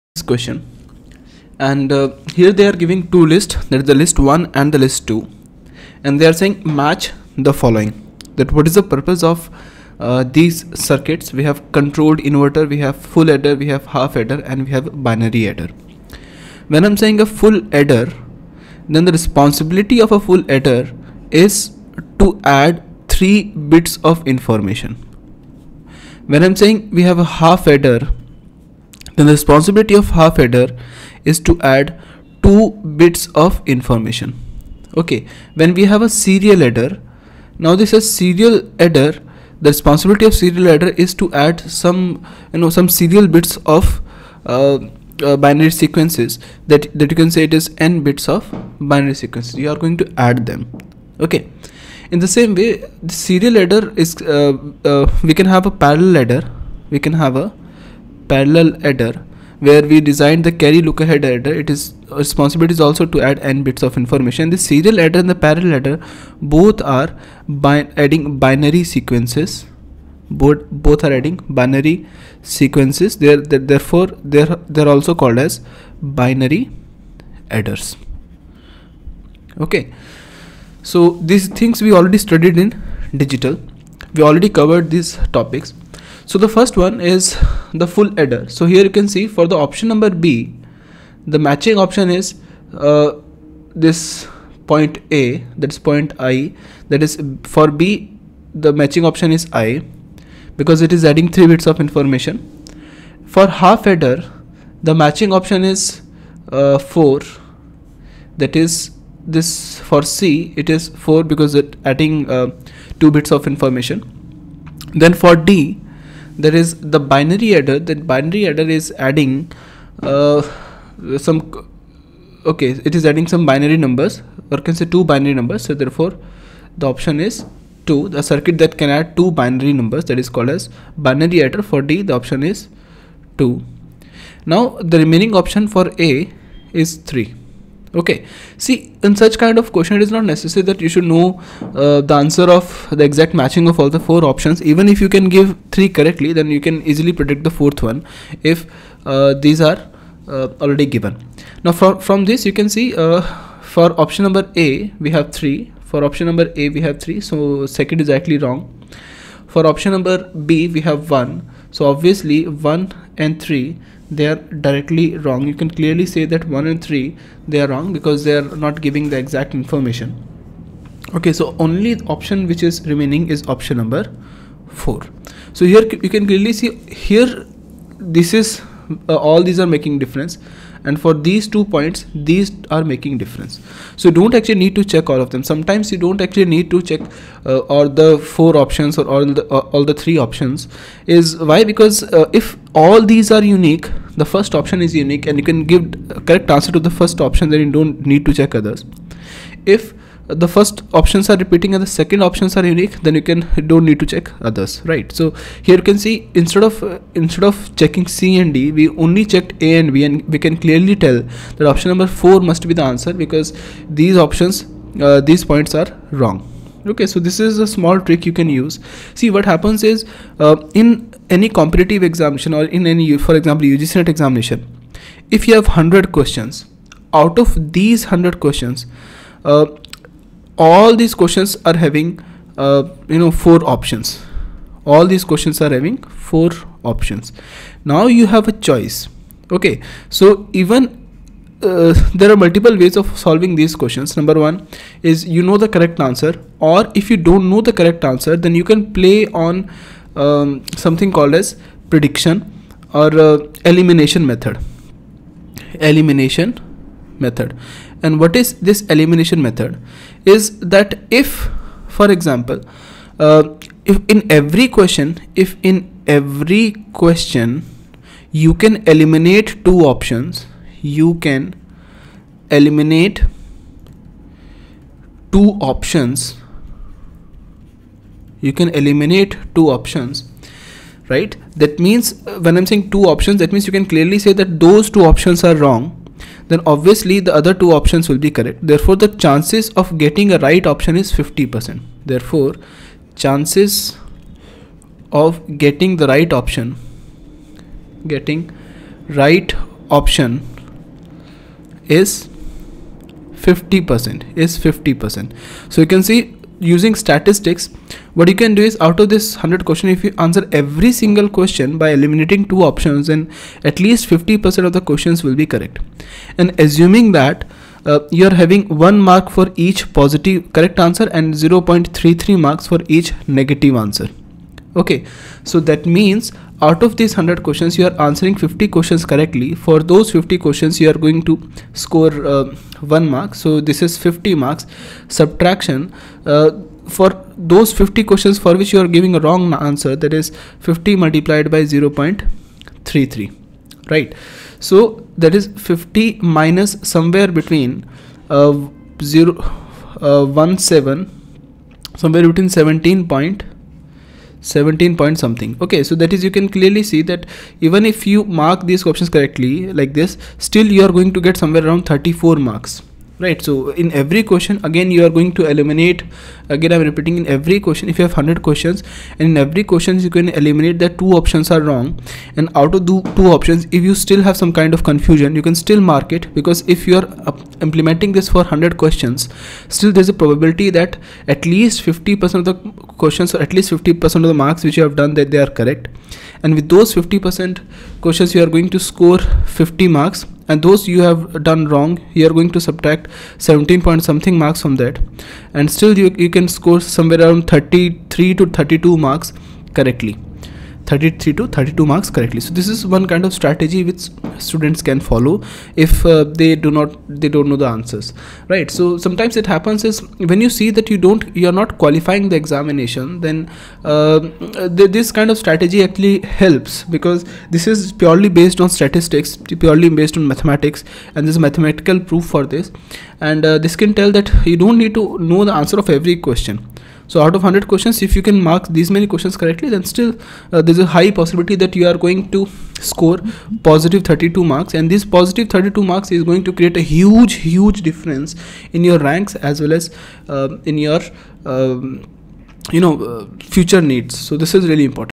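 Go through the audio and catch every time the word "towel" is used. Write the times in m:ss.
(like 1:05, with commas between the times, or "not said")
not said.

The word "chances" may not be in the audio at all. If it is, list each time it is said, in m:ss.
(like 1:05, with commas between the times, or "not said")
4:49, 4:53.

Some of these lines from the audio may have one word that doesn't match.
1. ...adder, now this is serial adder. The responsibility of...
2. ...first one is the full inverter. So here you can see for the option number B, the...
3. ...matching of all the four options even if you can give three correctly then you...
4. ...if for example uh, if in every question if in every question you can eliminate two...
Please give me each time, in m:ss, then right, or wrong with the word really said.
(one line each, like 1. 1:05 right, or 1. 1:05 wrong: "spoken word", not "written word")
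1. 0:36 right
2. 1:26 wrong: "adder", not "inverter"
3. 2:23 right
4. 4:21 right.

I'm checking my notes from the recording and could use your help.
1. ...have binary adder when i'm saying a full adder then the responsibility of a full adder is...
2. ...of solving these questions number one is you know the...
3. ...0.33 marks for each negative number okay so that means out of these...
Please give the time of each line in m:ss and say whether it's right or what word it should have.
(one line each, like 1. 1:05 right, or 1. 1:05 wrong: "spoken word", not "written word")
1. 0:14 right
2. 4:03 right
3. 5:21 wrong: "answer", not "number".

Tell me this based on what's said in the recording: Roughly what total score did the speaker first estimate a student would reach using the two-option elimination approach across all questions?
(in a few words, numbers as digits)
34 marks.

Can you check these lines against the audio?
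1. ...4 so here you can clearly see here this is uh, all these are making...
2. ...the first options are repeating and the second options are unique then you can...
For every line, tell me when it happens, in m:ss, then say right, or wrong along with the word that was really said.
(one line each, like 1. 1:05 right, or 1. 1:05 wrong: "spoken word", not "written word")
1. 2:54 right
2. 3:20 right.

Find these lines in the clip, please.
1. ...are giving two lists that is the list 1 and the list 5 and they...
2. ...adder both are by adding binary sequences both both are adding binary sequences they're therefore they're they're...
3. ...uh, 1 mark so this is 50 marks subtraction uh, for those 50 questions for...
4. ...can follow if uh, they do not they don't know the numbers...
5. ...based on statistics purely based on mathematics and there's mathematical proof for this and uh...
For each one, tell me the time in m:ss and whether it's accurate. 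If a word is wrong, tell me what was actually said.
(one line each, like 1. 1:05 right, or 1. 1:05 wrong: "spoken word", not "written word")
1. 0:02 wrong: "2", not "5"
2. 1:05 right
3. 5:32 right
4. 6:44 wrong: "answers", not "numbers"
5. 6:58 right.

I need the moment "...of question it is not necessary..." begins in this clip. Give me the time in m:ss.
2:19.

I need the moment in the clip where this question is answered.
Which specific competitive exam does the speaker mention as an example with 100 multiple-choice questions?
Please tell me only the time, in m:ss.
3:43.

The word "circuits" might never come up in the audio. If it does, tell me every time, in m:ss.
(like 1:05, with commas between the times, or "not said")
0:10, 2:08.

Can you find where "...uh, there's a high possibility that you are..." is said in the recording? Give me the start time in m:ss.
7:10.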